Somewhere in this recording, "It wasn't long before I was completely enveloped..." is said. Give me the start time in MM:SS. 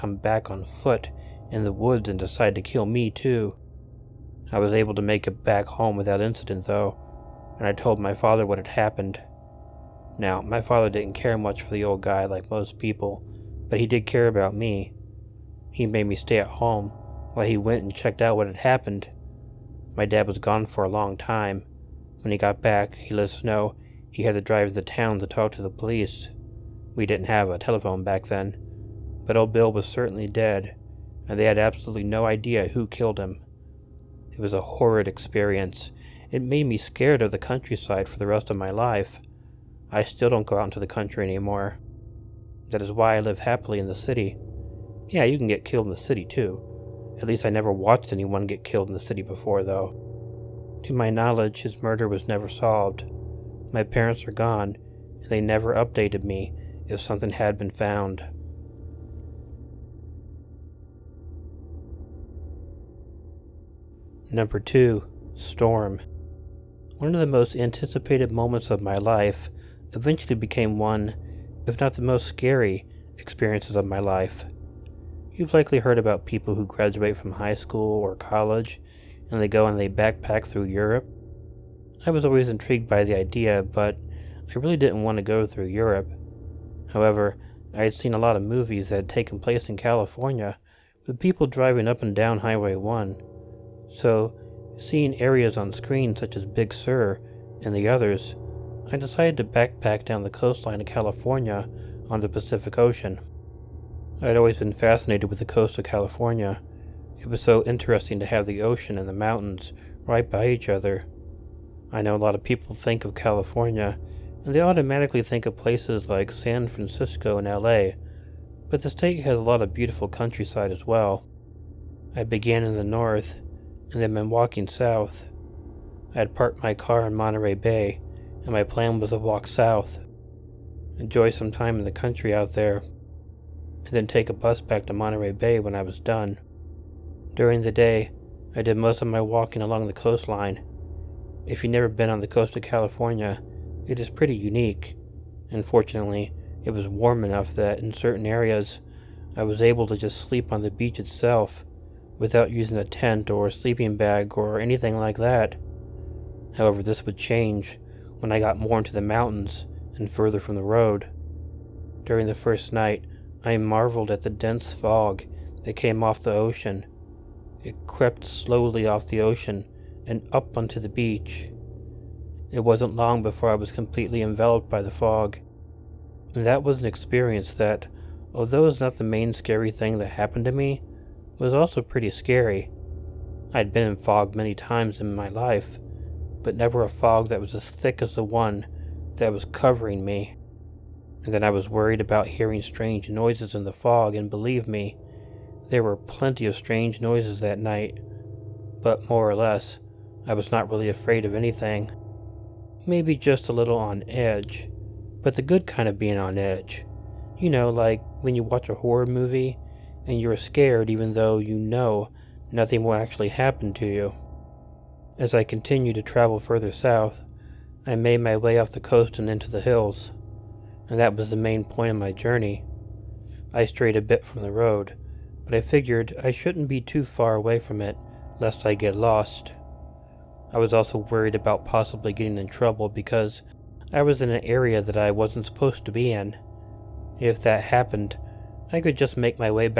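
02:52.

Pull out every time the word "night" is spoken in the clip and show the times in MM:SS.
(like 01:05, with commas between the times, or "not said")
02:42, 03:17.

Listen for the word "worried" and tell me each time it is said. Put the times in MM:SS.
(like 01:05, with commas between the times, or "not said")
03:11, 03:50.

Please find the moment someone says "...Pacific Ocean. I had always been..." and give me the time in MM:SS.
01:42.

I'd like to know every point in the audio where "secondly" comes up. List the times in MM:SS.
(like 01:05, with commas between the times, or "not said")
not said.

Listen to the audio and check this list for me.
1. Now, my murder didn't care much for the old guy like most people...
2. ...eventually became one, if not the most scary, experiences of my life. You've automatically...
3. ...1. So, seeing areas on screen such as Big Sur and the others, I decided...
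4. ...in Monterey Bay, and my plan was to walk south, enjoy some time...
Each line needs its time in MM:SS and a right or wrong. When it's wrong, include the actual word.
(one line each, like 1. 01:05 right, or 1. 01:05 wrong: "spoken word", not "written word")
1. 00:10 wrong: "father", not "murder"
2. 01:09 wrong: "likely", not "automatically"
3. 01:32 right
4. 02:07 right.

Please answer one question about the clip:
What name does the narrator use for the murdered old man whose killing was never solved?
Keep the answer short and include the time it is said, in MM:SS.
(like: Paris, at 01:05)
Bill, at 00:29.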